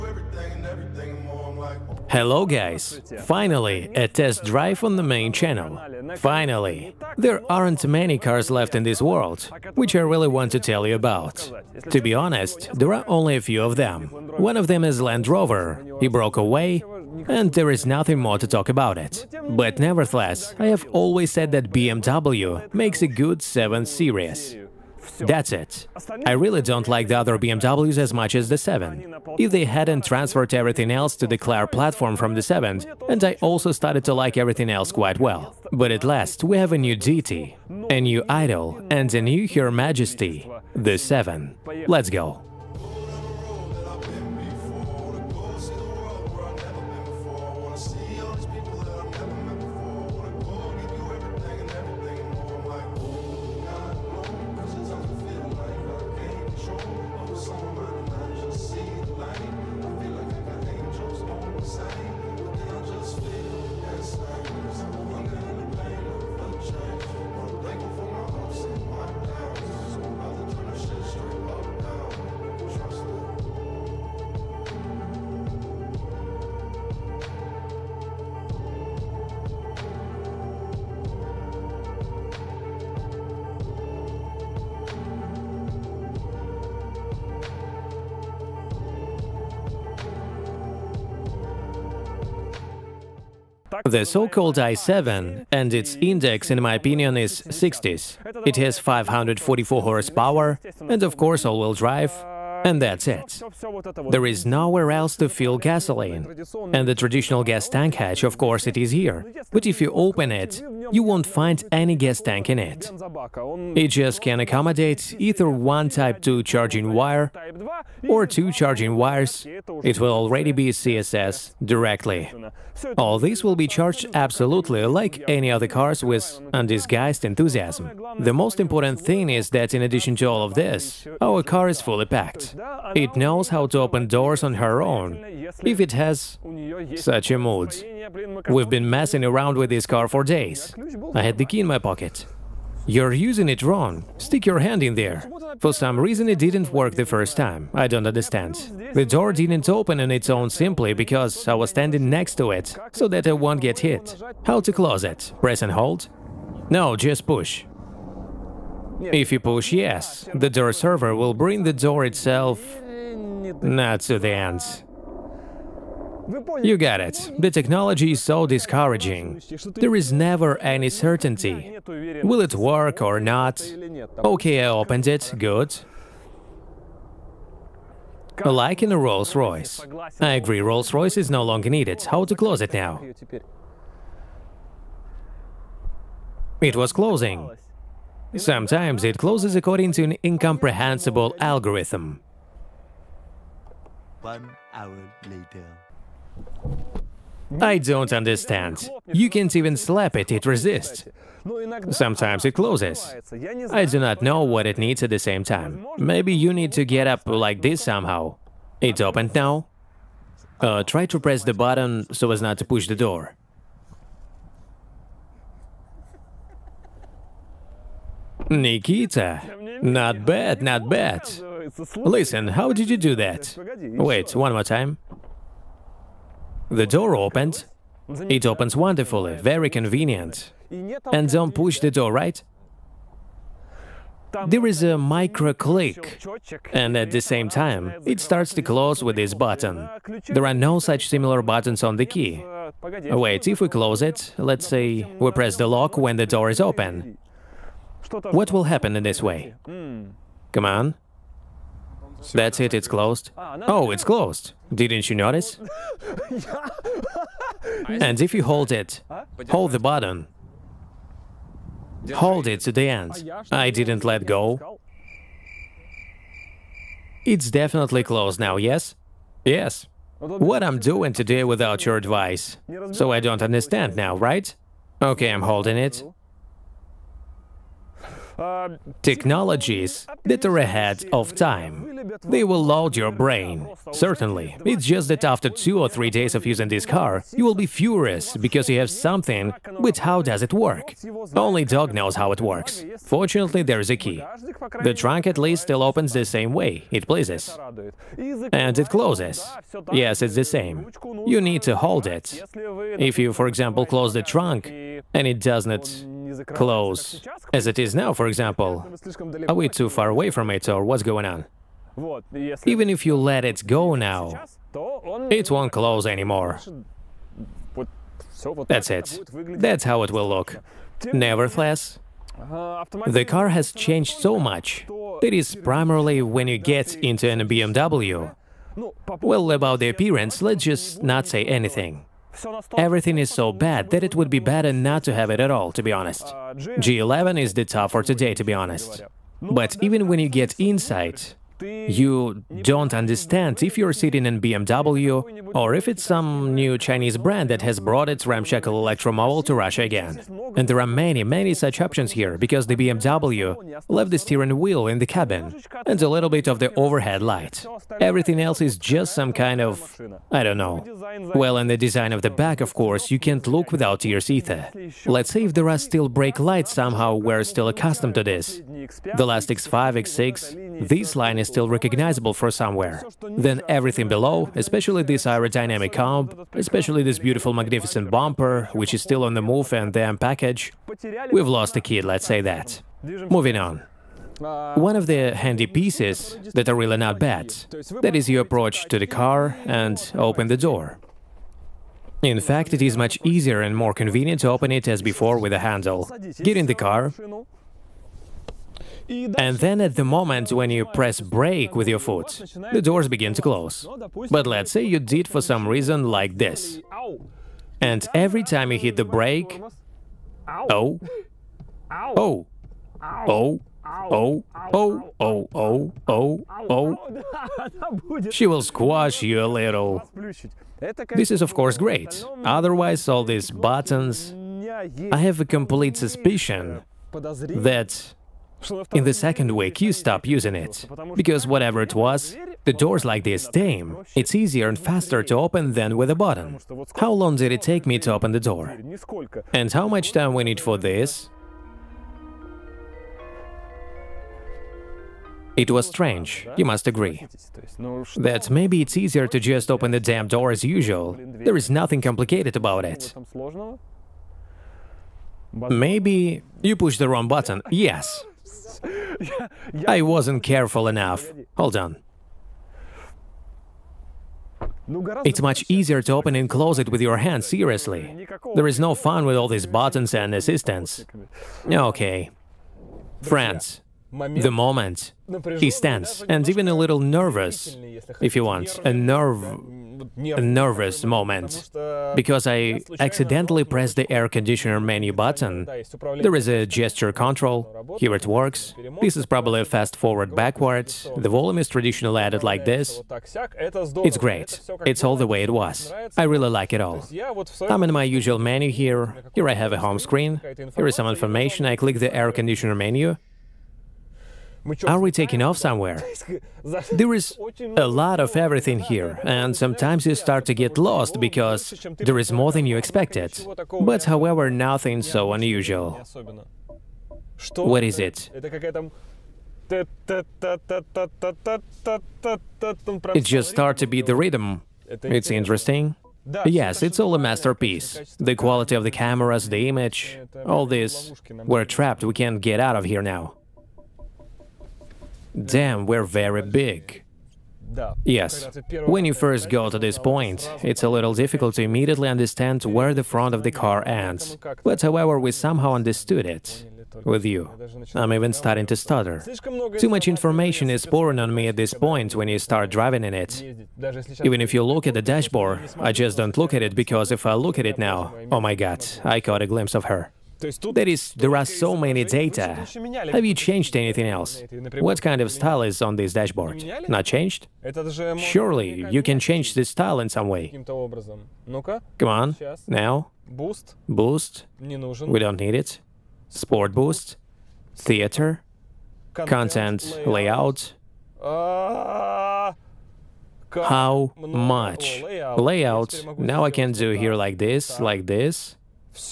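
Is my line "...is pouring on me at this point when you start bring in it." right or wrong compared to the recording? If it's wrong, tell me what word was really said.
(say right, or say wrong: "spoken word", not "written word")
wrong: "driving", not "bring".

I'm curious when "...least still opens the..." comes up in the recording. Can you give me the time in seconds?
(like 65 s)
295 s.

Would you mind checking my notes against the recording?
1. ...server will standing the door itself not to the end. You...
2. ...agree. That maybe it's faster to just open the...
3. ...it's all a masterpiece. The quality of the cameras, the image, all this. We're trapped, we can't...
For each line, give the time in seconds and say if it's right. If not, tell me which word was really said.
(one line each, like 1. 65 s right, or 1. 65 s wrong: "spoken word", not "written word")
1. 160 s wrong: "bring", not "standing"
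2. 446 s wrong: "easier", not "faster"
3. 526 s right.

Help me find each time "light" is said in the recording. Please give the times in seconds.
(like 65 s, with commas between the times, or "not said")
357 s, 366 s.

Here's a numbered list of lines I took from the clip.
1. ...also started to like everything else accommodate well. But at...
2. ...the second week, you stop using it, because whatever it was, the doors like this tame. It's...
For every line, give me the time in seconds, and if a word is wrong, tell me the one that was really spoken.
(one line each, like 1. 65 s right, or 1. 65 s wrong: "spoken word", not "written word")
1. 33 s wrong: "quite", not "accommodate"
2. 429 s right.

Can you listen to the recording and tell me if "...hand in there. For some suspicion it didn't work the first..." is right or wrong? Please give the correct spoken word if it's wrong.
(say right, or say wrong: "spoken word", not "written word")
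wrong: "reason", not "suspicion".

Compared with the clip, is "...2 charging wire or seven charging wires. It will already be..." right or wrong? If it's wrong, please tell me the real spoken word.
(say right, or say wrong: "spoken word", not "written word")
wrong: "two", not "seven".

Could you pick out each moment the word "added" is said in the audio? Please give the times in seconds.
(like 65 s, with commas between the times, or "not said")
492 s.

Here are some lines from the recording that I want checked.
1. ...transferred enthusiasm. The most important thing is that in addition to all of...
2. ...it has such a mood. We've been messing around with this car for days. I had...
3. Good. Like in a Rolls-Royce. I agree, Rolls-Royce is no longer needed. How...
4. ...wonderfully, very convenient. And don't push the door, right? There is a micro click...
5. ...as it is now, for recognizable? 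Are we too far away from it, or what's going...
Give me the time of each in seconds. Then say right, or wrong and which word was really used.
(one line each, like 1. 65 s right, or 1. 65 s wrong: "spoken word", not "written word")
1. 126 s wrong: "undisguised", not "transferred"
2. 135 s right
3. 175 s right
4. 228 s right
5. 307 s wrong: "example", not "recognizable".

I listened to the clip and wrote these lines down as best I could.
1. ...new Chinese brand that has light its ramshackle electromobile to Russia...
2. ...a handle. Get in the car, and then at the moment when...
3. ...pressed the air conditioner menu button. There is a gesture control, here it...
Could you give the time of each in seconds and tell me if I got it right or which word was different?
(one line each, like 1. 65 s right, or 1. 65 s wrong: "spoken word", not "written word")
1. 346 s wrong: "brought", not "light"
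2. 395 s right
3. 483 s right.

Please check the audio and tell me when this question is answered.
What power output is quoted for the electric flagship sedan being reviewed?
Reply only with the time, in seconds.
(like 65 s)
98 s.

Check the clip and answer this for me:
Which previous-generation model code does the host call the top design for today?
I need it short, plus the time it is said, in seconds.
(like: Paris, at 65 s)
G11, at 336 s.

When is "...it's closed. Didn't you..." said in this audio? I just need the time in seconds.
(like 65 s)
253 s.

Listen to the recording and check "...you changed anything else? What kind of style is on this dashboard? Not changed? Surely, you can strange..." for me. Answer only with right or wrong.
wrong.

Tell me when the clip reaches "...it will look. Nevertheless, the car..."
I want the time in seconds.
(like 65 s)
320 s.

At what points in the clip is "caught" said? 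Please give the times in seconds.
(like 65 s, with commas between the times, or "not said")
559 s.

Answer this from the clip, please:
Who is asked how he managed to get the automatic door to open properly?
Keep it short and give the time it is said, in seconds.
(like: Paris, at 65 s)
Nikita, at 218 s.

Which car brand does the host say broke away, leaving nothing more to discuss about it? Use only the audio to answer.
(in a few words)
Land Rover.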